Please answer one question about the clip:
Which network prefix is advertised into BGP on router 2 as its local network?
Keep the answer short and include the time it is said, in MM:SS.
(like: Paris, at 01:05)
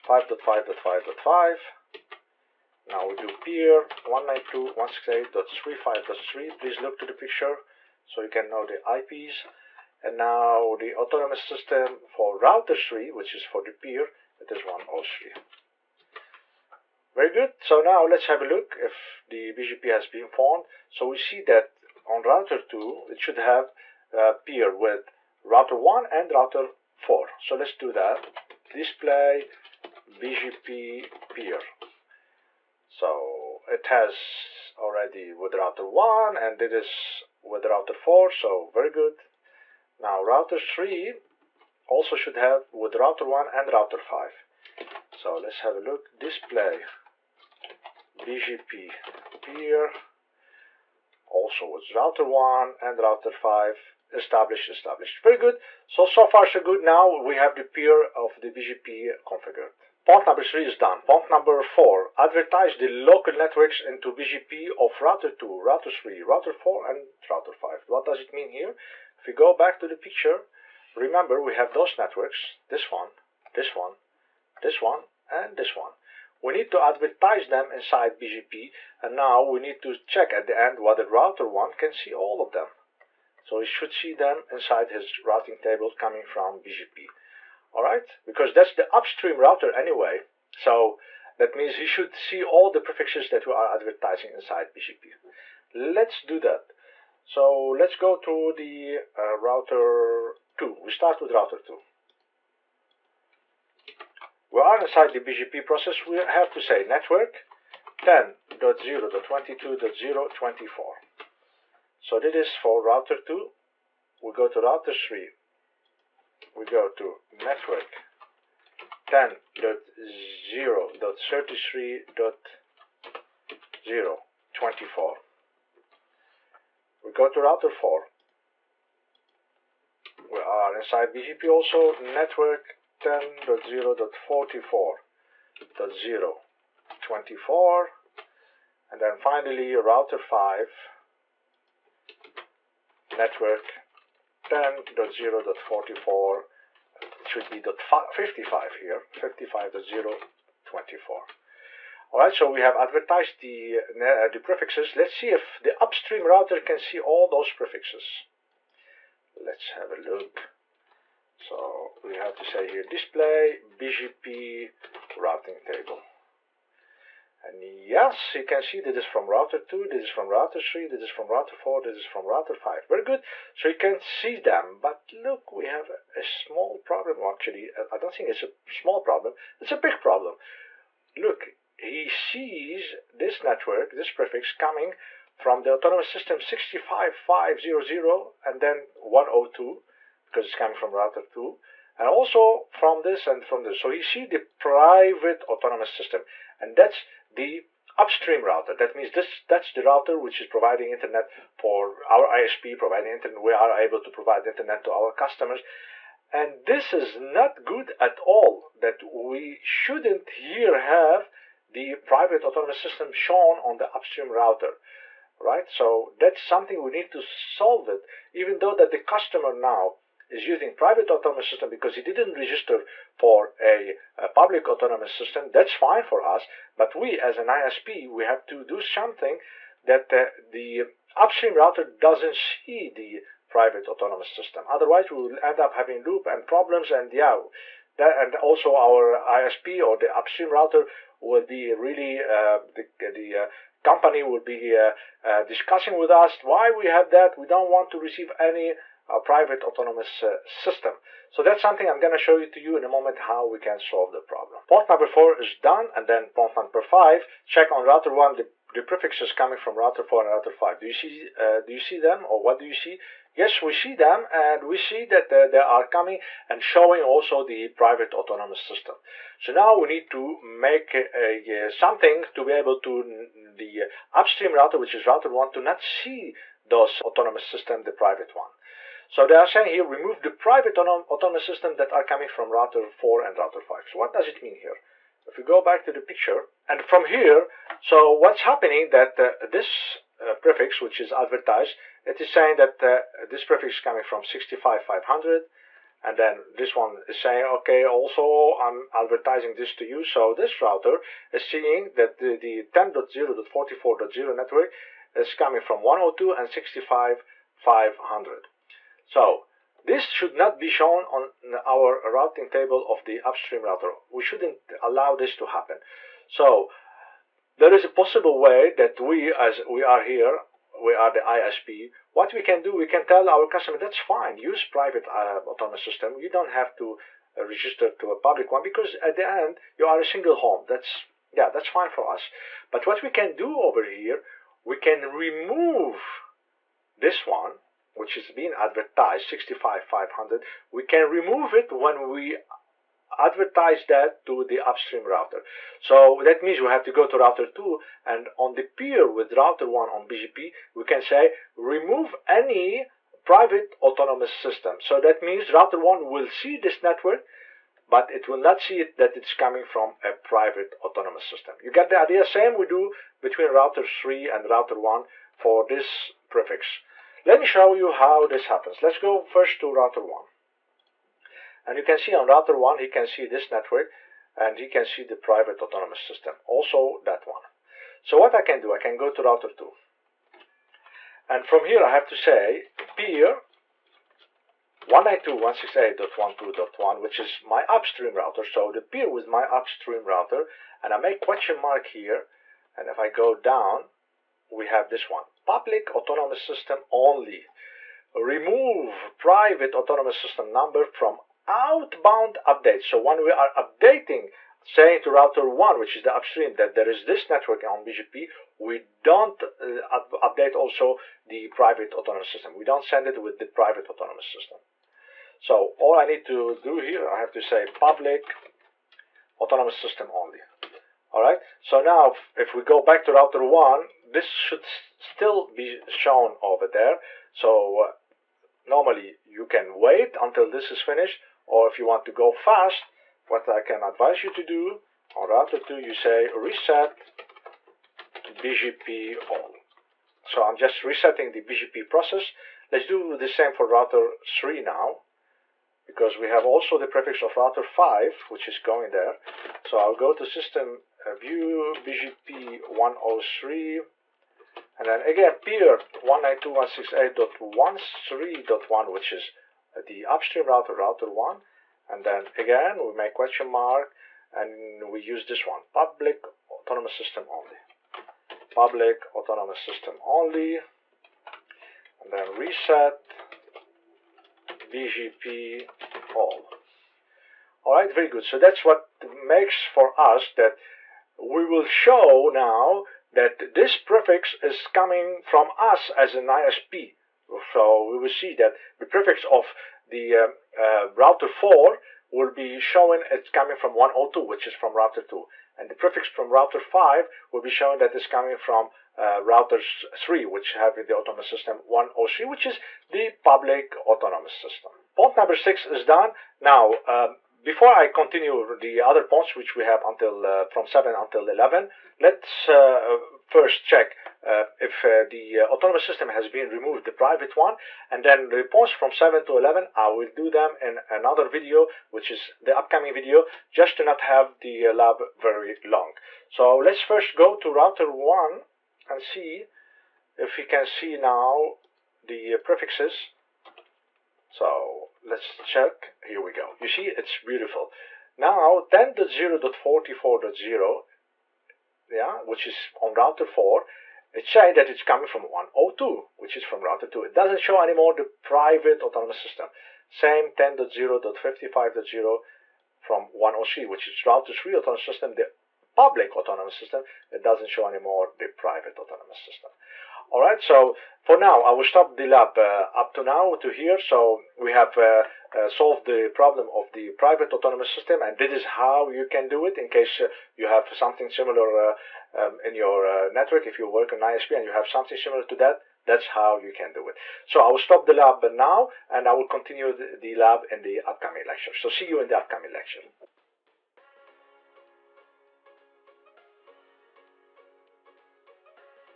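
10.0.22.0/24, at 01:47.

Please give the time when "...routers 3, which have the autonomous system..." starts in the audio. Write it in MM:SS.
08:19.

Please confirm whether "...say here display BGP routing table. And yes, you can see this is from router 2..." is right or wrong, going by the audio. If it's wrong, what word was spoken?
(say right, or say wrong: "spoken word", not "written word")
right.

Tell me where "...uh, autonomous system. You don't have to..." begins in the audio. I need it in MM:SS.
05:25.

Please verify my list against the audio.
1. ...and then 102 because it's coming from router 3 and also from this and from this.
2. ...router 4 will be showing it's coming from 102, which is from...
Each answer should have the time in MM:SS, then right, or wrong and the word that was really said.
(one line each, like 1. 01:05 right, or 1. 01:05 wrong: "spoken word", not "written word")
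1. 03:08 wrong: "2", not "3"
2. 08:10 right.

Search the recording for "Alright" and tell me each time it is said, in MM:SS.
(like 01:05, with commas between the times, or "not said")
01:27, 02:32.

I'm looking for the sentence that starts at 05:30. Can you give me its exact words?
That's, yeah, that's fine for us.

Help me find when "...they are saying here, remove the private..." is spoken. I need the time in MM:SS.
04:39.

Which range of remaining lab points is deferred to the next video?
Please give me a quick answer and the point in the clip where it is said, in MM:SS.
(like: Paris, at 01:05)
7 to 11, at 08:30.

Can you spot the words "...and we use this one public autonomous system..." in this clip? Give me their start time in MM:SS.
07:44.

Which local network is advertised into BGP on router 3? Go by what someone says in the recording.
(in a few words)
10.0.33.0/24.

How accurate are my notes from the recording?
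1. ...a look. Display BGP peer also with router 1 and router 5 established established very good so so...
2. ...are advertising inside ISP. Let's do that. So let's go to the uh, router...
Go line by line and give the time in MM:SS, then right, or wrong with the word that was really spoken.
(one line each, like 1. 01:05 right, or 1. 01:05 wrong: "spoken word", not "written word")
1. 00:45 right
2. 01:33 wrong: "BGP", not "ISP".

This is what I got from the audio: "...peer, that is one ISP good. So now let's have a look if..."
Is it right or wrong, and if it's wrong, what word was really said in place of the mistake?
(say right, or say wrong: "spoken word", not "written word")
wrong: "Very", not "ISP".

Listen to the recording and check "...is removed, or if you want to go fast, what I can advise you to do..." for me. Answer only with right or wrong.
wrong.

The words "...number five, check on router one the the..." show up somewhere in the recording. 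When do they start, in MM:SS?
04:16.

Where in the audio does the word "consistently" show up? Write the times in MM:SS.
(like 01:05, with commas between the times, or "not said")
not said.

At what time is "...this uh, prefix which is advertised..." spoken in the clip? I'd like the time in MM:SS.
04:49.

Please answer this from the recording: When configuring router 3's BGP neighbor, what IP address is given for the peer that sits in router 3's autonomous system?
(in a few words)
192.168.35.3.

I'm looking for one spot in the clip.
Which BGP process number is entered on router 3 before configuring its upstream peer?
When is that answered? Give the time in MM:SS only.
07:31.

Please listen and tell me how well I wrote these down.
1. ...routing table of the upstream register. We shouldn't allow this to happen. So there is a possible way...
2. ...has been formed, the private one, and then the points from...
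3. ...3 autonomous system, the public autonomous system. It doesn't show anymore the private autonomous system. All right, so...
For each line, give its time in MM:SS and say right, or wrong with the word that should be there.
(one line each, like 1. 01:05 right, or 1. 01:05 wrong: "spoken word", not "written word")
1. 05:12 wrong: "router", not "register"
2. 08:36 wrong: "removed", not "formed"
3. 09:14 right.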